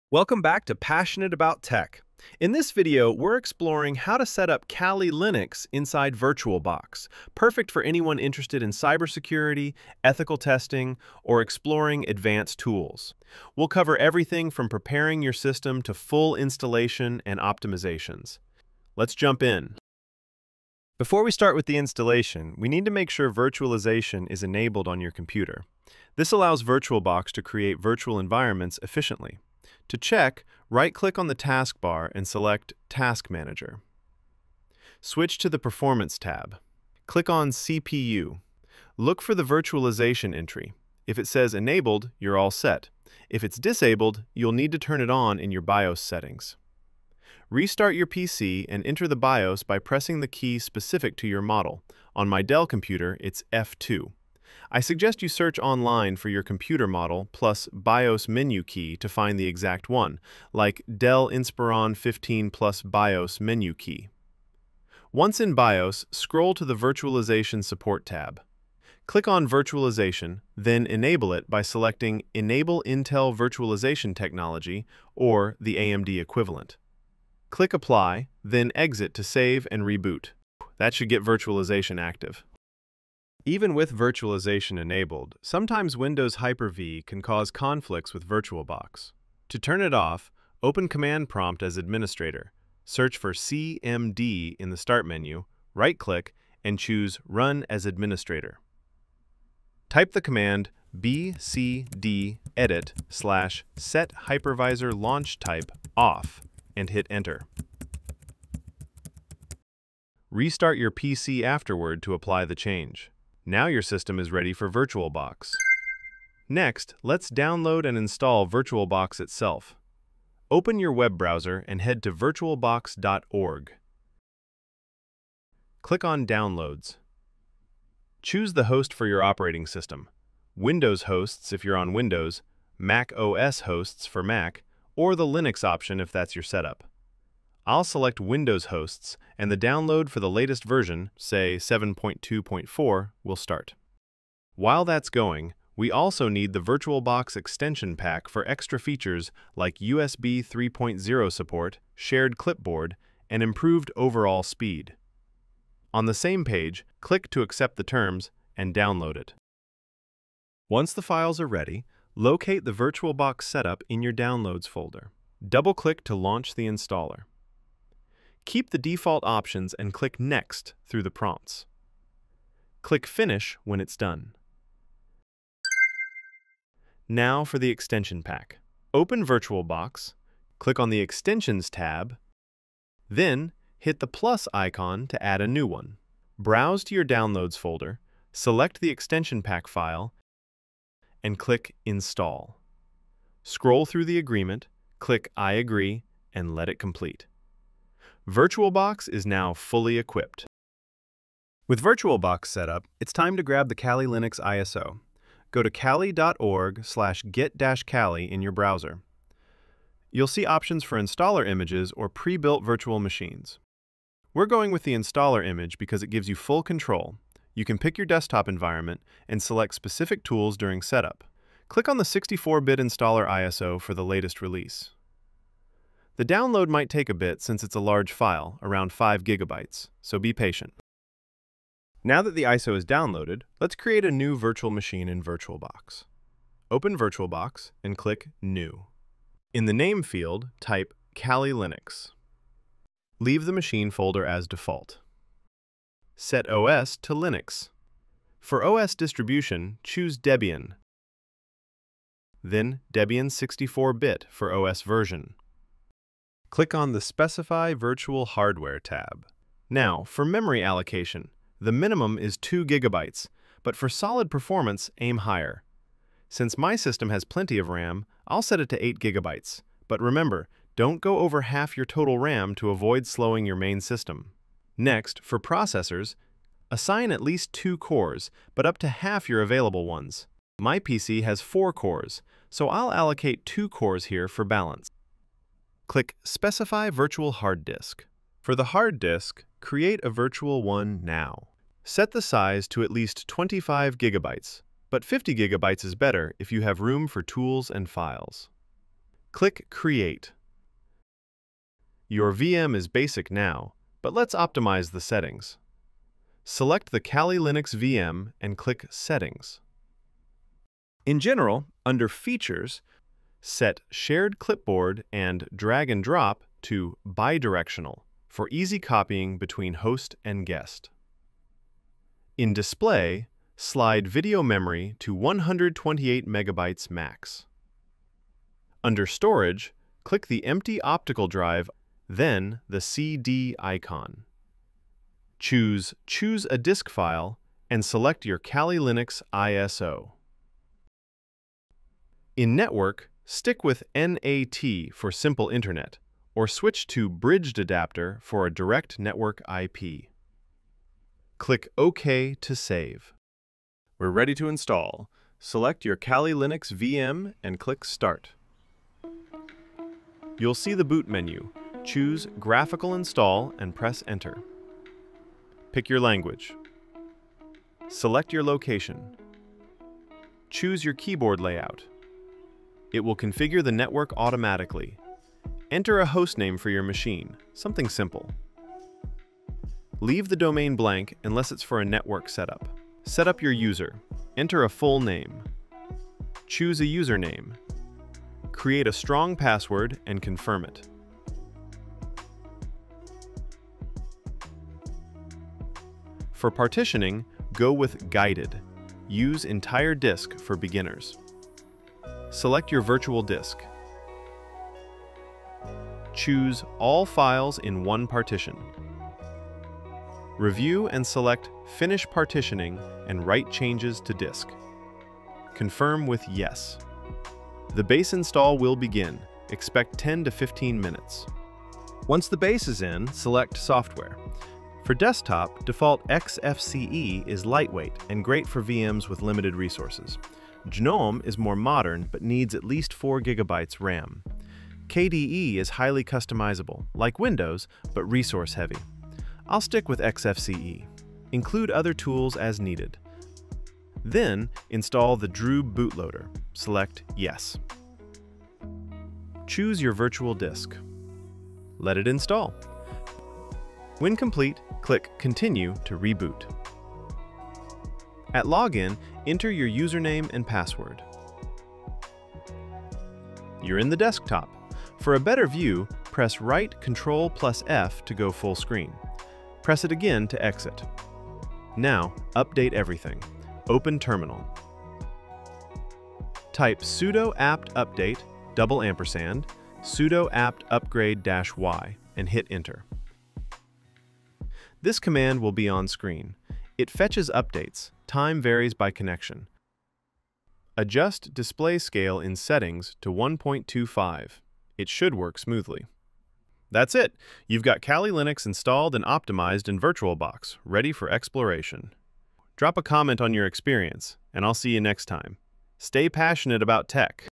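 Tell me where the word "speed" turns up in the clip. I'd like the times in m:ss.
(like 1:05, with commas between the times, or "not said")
2:34.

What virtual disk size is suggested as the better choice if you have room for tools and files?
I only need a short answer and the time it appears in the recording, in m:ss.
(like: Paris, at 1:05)
50 gigabytes, at 4:55.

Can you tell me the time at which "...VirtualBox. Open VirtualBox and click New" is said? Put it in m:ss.
3:55.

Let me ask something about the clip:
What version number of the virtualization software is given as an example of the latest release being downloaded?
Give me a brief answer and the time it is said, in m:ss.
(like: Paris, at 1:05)
7.2.4, at 2:21.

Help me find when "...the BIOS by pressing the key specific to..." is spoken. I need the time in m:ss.
0:49.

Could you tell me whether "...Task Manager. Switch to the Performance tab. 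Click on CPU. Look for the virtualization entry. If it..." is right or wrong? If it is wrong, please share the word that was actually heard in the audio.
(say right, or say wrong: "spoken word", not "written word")
right.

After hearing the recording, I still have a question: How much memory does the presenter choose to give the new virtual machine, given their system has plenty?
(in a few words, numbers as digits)
8 gigabytes.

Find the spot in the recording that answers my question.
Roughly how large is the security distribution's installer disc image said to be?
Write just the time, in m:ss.
3:48.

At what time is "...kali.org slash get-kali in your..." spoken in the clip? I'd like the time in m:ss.
3:25.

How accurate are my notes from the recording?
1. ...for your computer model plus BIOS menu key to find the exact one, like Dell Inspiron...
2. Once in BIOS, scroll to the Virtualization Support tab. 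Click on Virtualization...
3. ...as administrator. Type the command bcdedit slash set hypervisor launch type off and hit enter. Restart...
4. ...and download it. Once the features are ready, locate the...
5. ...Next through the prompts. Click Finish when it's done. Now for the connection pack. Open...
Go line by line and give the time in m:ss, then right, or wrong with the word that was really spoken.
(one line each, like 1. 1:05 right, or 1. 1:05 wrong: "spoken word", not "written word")
1. 0:56 right
2. 1:05 right
3. 1:37 right
4. 2:38 wrong: "files", not "features"
5. 2:50 wrong: "extension", not "connection".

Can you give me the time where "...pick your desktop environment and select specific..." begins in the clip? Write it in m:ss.
3:37.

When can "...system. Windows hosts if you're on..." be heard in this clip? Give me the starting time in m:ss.
2:09.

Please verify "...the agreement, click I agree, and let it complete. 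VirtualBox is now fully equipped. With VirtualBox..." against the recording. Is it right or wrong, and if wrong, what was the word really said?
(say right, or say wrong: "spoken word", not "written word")
right.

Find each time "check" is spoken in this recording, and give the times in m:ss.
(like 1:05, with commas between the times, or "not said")
0:29.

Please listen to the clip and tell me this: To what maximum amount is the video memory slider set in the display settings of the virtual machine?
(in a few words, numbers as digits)
128 megabytes.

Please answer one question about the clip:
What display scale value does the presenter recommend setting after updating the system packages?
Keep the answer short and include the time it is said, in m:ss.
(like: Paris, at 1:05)
1.25, at 8:13.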